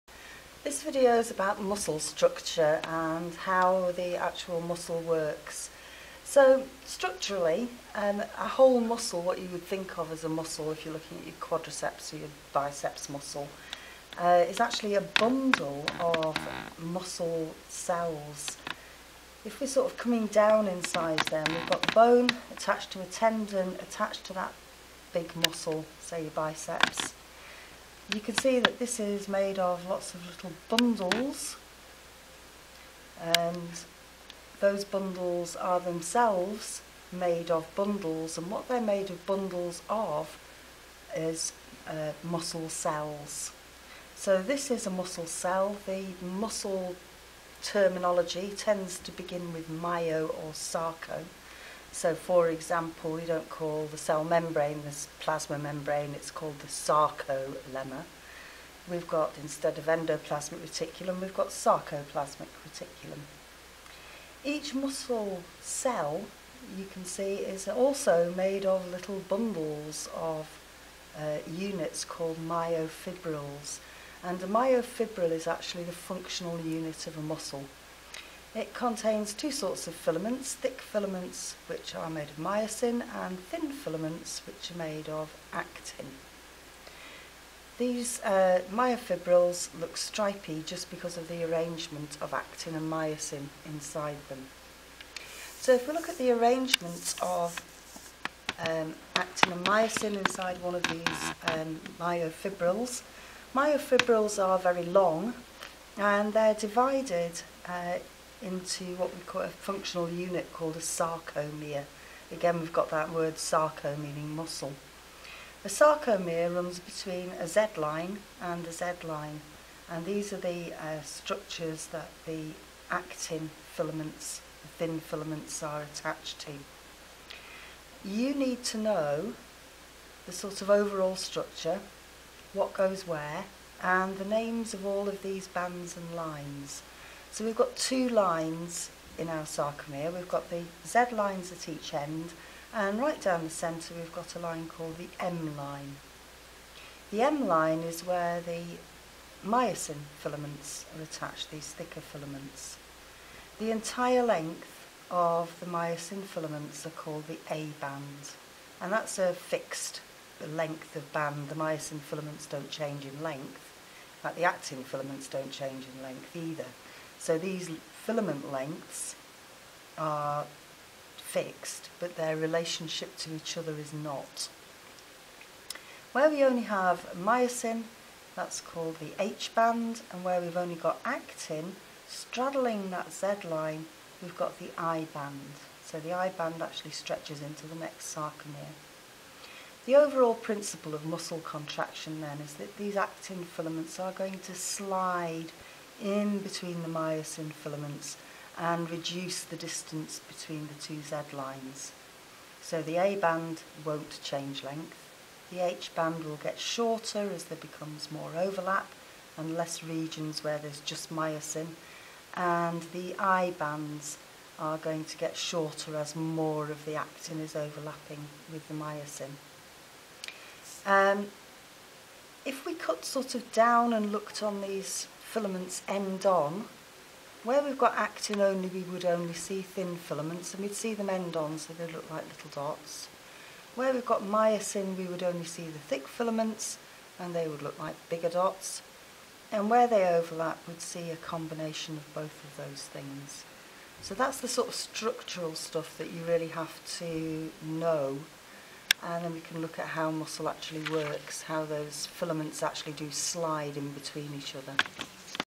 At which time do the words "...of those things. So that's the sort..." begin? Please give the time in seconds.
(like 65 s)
242 s.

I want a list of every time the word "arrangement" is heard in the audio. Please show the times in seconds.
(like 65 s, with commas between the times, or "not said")
91 s, 96 s.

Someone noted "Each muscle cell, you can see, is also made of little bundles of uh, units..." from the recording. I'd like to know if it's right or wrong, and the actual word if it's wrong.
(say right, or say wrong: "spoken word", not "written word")
right.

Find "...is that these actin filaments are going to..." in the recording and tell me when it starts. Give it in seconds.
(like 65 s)
192 s.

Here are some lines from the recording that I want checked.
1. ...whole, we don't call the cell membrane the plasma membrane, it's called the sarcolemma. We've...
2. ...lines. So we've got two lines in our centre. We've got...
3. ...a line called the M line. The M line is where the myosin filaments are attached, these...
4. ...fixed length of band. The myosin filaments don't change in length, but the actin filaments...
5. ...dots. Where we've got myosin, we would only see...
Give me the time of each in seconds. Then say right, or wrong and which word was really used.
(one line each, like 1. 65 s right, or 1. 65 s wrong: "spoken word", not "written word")
1. 52 s wrong: "example", not "whole"
2. 136 s wrong: "sarcomere", not "centre"
3. 144 s right
4. 159 s right
5. 232 s right.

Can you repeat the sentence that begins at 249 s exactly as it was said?
And then we can look at how muscle actually works, how those filaments actually do slide in between each other.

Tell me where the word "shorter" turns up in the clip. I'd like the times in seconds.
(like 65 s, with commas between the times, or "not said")
206 s, 215 s.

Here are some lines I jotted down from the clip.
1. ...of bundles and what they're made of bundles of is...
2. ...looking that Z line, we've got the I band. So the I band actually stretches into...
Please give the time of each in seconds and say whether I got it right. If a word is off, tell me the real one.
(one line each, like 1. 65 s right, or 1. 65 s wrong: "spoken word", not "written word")
1. 37 s right
2. 182 s wrong: "straddling", not "looking".